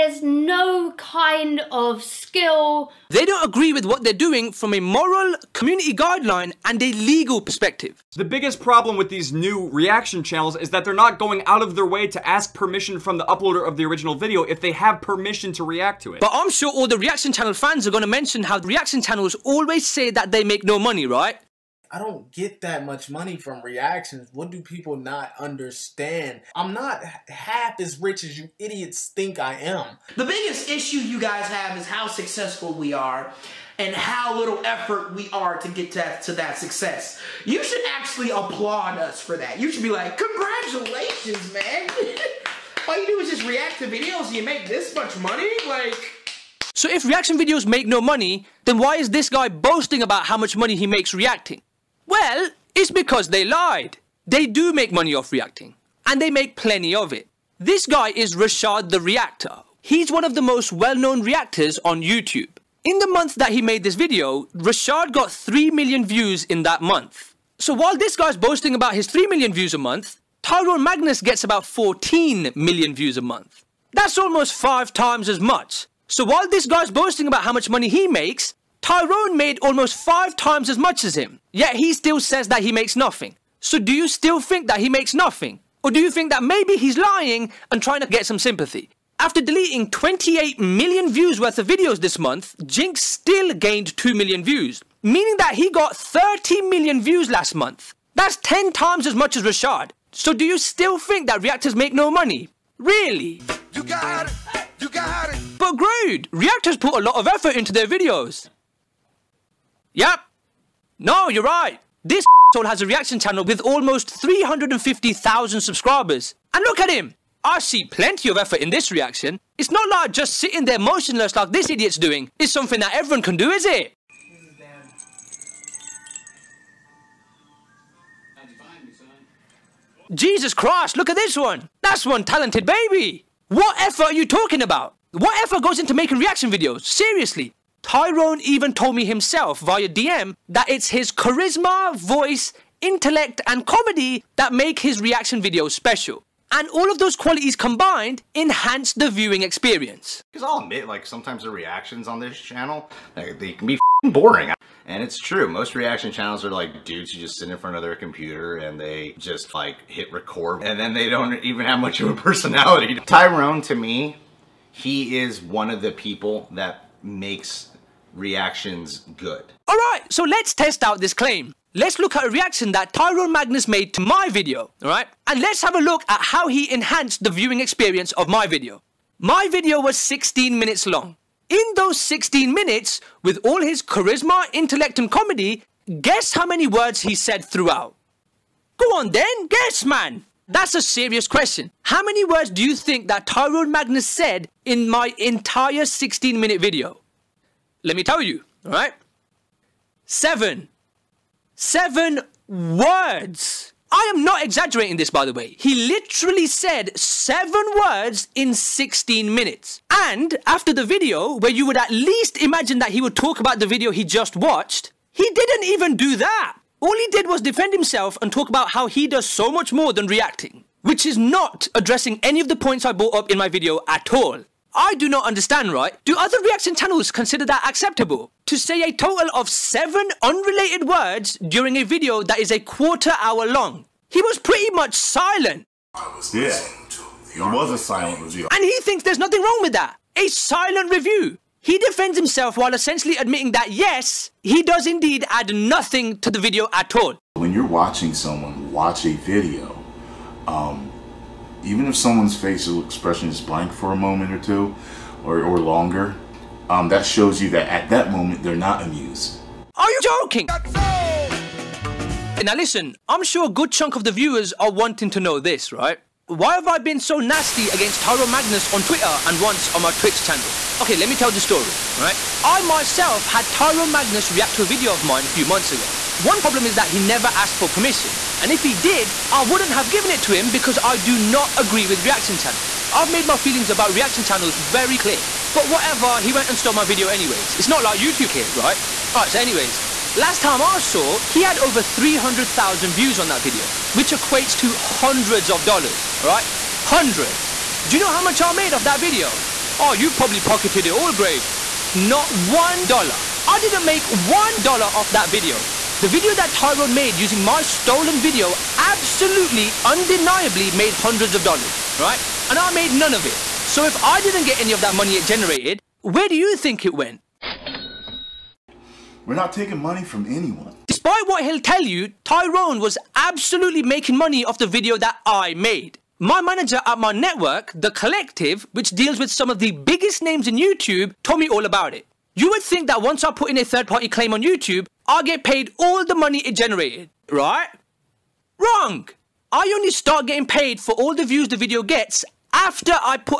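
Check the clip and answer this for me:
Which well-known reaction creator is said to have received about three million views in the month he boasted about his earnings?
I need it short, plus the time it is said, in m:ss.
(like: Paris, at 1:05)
Rashad the Reactor, at 0:58.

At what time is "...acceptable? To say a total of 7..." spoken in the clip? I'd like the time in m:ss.
3:47.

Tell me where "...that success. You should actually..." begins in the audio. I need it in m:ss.
0:36.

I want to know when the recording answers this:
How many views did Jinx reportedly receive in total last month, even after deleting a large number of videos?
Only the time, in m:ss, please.
1:35.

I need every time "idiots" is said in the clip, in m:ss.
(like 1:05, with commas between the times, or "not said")
0:28, 2:01.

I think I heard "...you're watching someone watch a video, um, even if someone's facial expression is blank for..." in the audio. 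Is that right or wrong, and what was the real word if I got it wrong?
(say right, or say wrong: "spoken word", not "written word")
right.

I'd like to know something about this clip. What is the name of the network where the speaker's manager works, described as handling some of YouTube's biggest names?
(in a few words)
The Collective.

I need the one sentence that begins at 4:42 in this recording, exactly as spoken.
I've made my feelings about reaction channels very clear.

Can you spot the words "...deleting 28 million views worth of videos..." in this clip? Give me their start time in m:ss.
1:29.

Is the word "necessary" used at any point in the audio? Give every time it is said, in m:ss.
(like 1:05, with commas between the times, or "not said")
not said.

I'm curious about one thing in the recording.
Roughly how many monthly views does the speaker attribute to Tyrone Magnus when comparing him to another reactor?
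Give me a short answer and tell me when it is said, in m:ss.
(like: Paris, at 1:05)
14 million, at 1:11.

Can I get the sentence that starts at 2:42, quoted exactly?
Tyrone to me, he is one of the people that makes reactions good.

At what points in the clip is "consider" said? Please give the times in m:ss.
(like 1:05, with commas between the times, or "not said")
3:47.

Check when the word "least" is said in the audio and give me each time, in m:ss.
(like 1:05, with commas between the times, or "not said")
3:31.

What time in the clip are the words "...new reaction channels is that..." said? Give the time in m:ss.
0:09.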